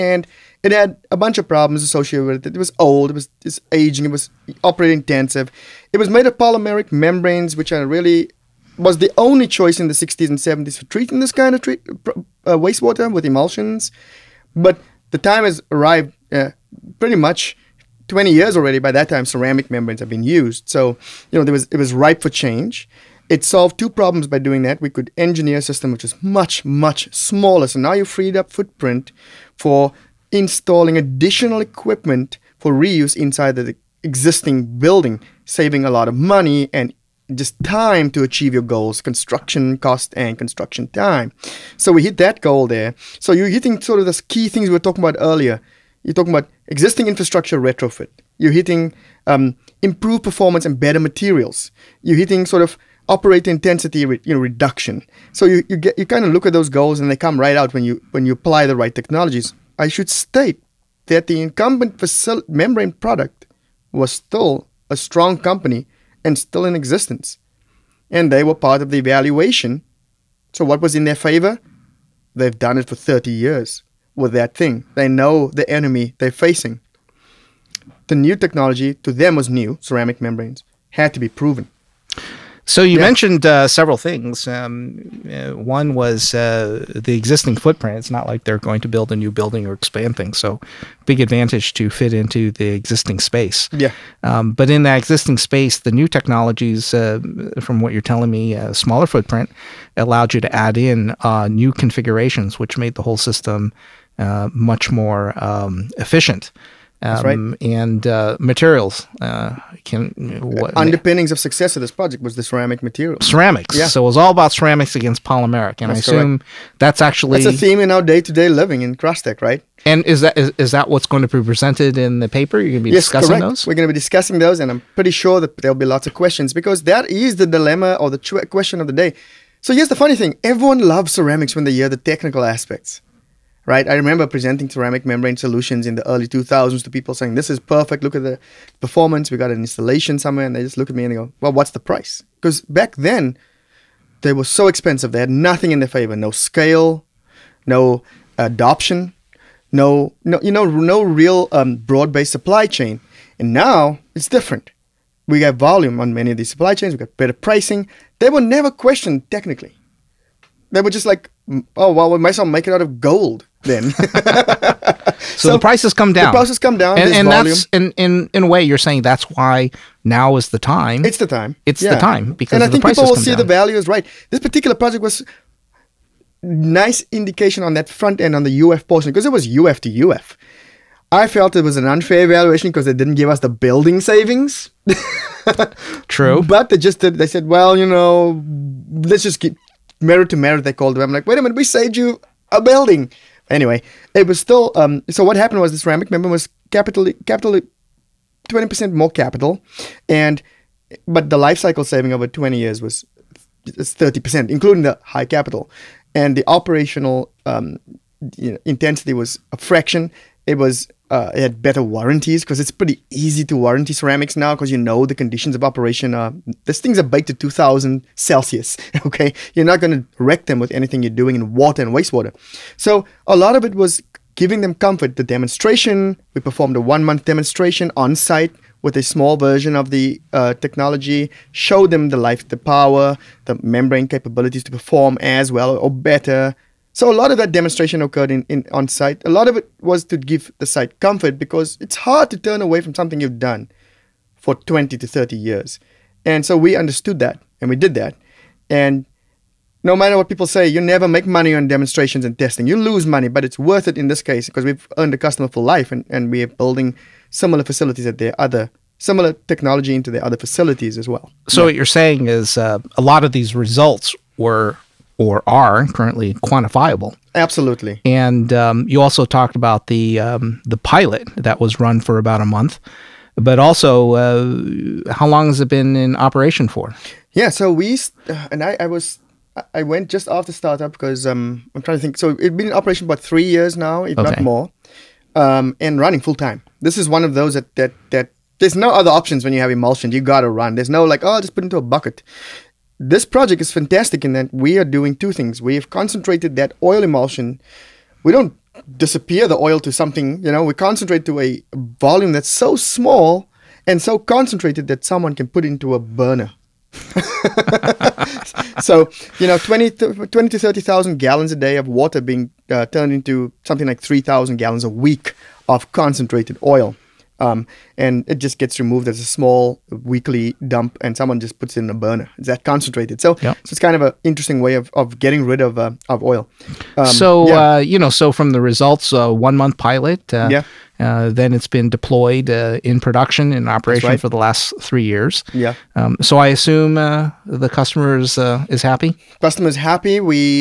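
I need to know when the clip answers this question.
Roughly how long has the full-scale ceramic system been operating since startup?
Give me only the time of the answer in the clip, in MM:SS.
04:43.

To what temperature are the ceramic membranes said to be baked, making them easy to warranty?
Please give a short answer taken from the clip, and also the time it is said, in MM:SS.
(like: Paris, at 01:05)
2000 Celsius, at 03:37.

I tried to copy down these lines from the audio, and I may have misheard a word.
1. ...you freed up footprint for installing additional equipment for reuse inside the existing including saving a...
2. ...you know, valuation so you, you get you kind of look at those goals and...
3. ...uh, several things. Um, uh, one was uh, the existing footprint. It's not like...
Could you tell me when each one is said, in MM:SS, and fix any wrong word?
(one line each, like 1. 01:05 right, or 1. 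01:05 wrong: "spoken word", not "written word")
1. 00:27 wrong: "building", not "including"
2. 00:53 wrong: "reduction", not "valuation"
3. 01:23 right.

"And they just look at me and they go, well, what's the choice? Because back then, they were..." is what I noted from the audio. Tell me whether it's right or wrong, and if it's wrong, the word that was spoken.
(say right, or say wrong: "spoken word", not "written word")
wrong: "price", not "choice".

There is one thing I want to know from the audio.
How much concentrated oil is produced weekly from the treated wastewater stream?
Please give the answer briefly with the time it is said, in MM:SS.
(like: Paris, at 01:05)
3,000 gallons, at 05:13.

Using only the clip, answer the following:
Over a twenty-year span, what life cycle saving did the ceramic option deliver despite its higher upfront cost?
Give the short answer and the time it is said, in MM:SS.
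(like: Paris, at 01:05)
30 percent, at 03:23.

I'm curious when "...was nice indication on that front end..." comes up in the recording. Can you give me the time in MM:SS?
02:55.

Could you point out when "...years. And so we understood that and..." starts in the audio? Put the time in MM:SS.
04:05.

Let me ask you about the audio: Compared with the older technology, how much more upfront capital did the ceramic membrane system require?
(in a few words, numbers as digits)
20 percent.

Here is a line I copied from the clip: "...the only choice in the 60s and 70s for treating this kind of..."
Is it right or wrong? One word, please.
right.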